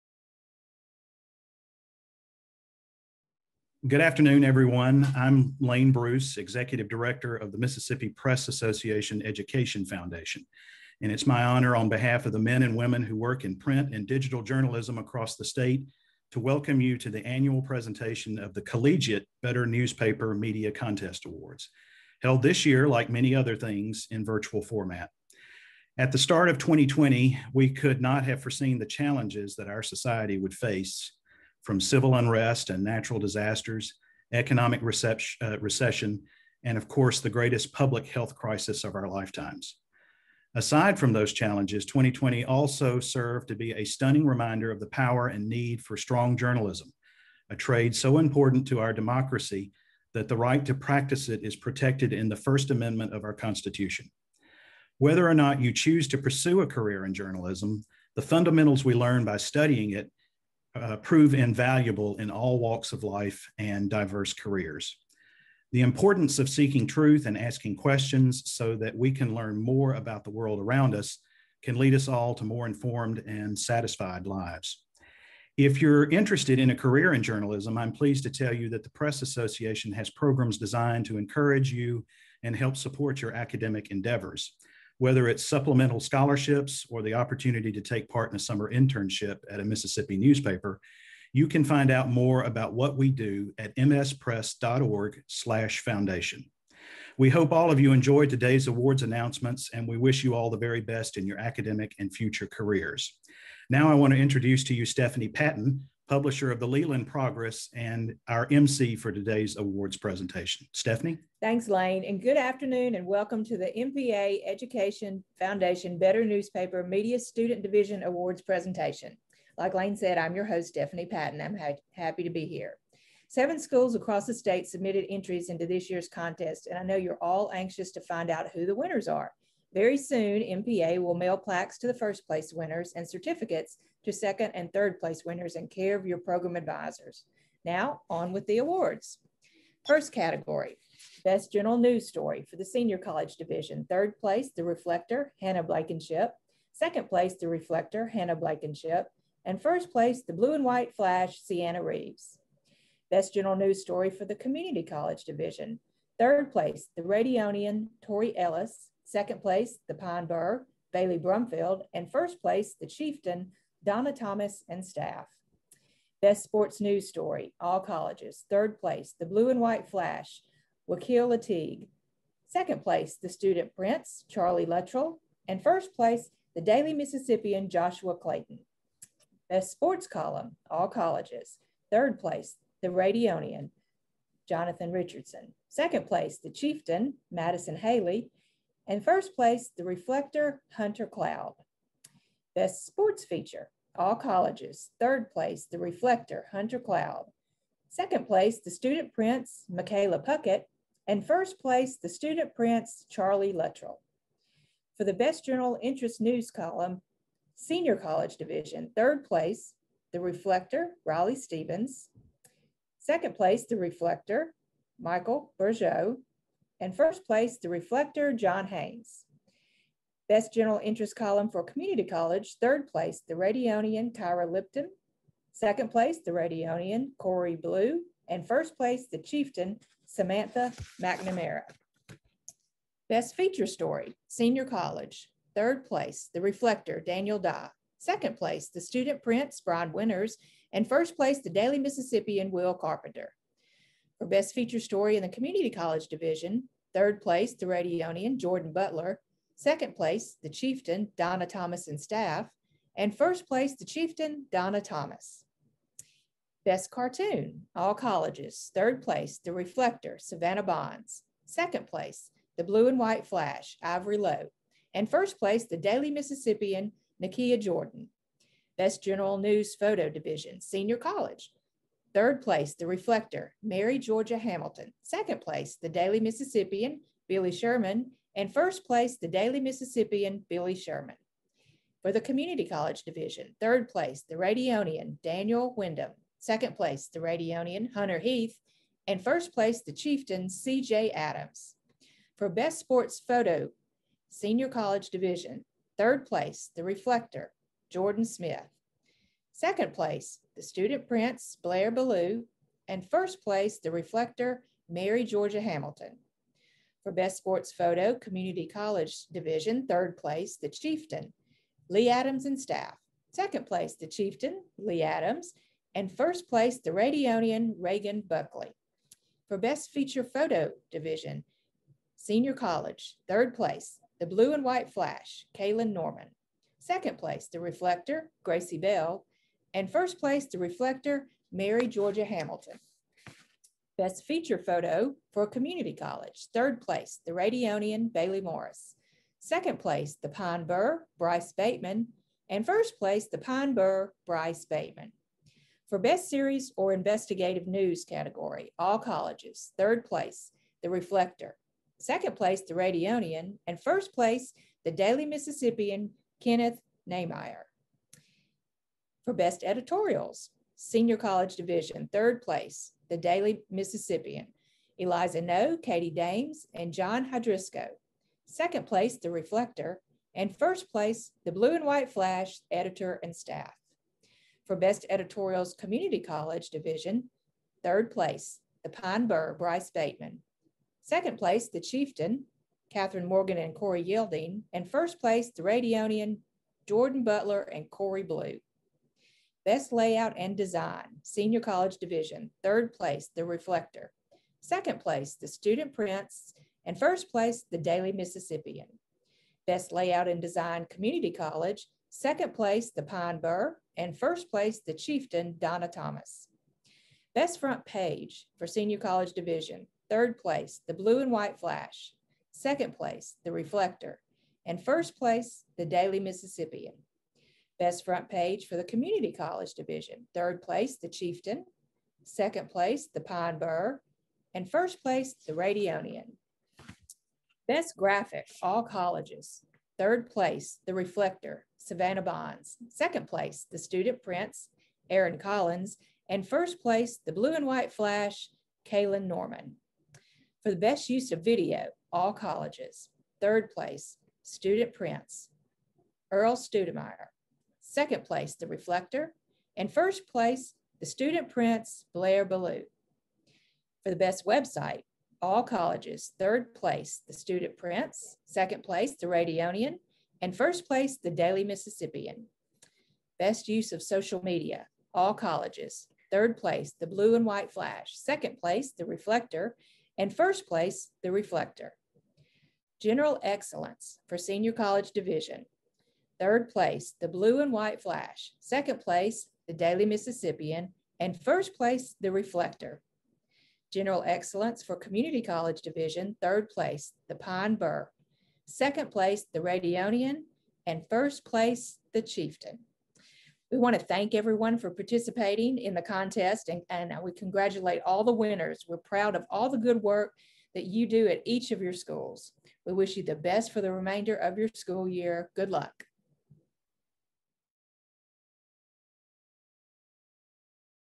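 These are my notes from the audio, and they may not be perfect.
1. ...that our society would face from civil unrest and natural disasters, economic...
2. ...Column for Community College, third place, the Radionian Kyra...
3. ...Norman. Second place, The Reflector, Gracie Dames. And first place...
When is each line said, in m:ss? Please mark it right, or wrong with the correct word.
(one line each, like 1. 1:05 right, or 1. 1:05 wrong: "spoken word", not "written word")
1. 0:29 right
2. 3:41 right
3. 5:25 wrong: "Bell", not "Dames".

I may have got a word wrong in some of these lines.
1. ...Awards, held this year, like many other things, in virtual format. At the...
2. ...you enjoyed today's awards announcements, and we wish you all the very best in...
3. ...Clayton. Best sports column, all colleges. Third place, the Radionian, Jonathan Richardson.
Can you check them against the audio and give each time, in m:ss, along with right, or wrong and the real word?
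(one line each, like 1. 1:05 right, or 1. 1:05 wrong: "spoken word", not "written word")
1. 0:21 right
2. 1:37 right
3. 2:58 right.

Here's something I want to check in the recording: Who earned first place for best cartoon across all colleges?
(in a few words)
Nakia Jordan.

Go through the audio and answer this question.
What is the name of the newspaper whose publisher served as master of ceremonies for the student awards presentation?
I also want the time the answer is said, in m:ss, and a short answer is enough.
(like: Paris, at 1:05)
Leland Progress, at 1:46.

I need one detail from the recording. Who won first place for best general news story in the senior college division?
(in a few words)
Sienna Reeves.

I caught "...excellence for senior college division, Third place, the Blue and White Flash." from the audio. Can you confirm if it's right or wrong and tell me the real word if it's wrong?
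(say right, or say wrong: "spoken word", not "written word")
right.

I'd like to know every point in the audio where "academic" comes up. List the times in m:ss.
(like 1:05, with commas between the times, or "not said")
1:23, 1:41.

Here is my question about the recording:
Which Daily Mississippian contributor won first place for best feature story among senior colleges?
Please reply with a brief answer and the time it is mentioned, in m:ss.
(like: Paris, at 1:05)
Will Carpenter, at 4:02.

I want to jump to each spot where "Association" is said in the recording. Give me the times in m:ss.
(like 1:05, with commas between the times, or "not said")
0:08, 1:19.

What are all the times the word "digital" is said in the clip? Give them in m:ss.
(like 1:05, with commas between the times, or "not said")
0:14.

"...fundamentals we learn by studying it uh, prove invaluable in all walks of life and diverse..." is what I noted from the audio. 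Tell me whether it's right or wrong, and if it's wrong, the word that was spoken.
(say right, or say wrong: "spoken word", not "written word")
right.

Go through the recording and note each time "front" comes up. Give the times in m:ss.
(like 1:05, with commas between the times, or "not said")
6:47, 6:58.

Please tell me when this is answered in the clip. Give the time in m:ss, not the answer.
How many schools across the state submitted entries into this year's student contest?
2:03.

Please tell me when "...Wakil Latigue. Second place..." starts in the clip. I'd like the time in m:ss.
2:50.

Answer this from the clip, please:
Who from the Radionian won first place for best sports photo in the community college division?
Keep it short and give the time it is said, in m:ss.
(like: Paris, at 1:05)
Reagan Buckley, at 5:17.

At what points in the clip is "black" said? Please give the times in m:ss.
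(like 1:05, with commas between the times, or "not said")
not said.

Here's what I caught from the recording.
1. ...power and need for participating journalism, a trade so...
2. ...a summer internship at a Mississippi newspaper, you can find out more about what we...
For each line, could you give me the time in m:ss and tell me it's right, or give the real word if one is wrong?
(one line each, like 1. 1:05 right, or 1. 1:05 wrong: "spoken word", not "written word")
1. 0:44 wrong: "strong", not "participating"
2. 1:28 right.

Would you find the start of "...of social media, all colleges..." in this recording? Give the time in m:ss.
7:43.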